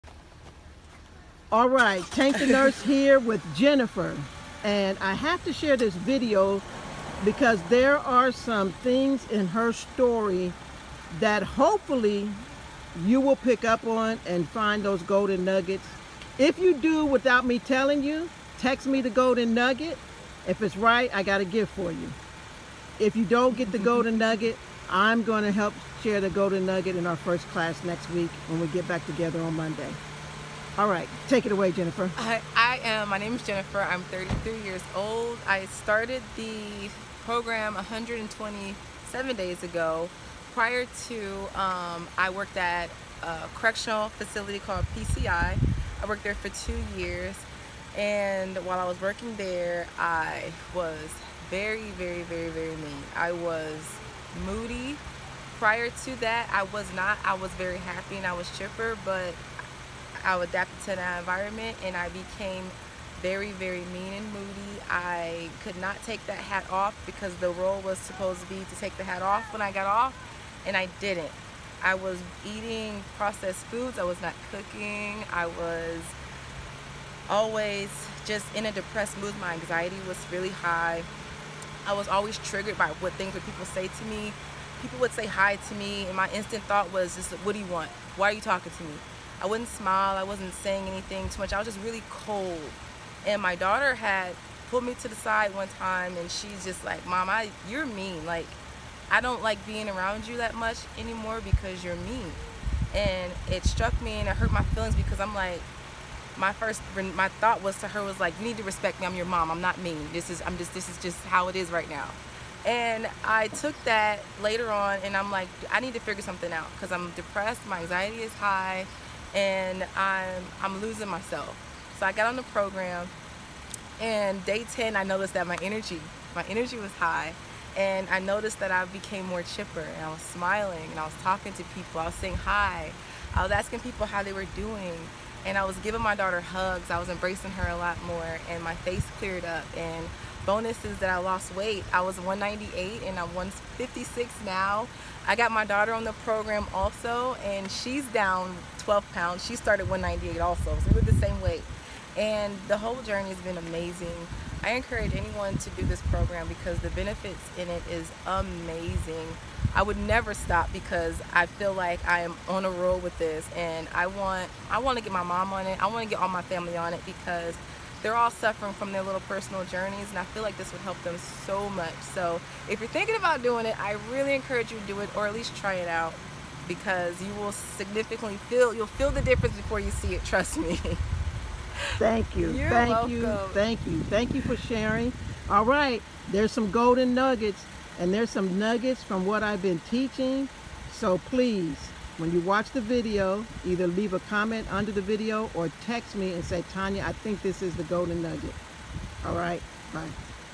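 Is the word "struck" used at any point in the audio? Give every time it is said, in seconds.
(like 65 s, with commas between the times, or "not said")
103 s.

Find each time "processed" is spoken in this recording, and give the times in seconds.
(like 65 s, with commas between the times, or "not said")
73 s.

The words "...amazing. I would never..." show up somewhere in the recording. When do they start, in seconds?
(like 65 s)
158 s.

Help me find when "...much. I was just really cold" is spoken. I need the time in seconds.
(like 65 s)
91 s.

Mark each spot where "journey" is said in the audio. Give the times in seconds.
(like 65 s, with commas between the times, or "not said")
153 s, 169 s.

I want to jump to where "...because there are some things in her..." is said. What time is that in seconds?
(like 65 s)
7 s.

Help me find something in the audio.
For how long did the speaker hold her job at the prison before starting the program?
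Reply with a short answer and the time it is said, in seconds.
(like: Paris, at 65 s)
2 years, at 46 s.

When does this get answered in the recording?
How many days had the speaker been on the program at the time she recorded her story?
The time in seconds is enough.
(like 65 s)
37 s.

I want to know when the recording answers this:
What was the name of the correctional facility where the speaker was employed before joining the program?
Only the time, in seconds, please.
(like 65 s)
44 s.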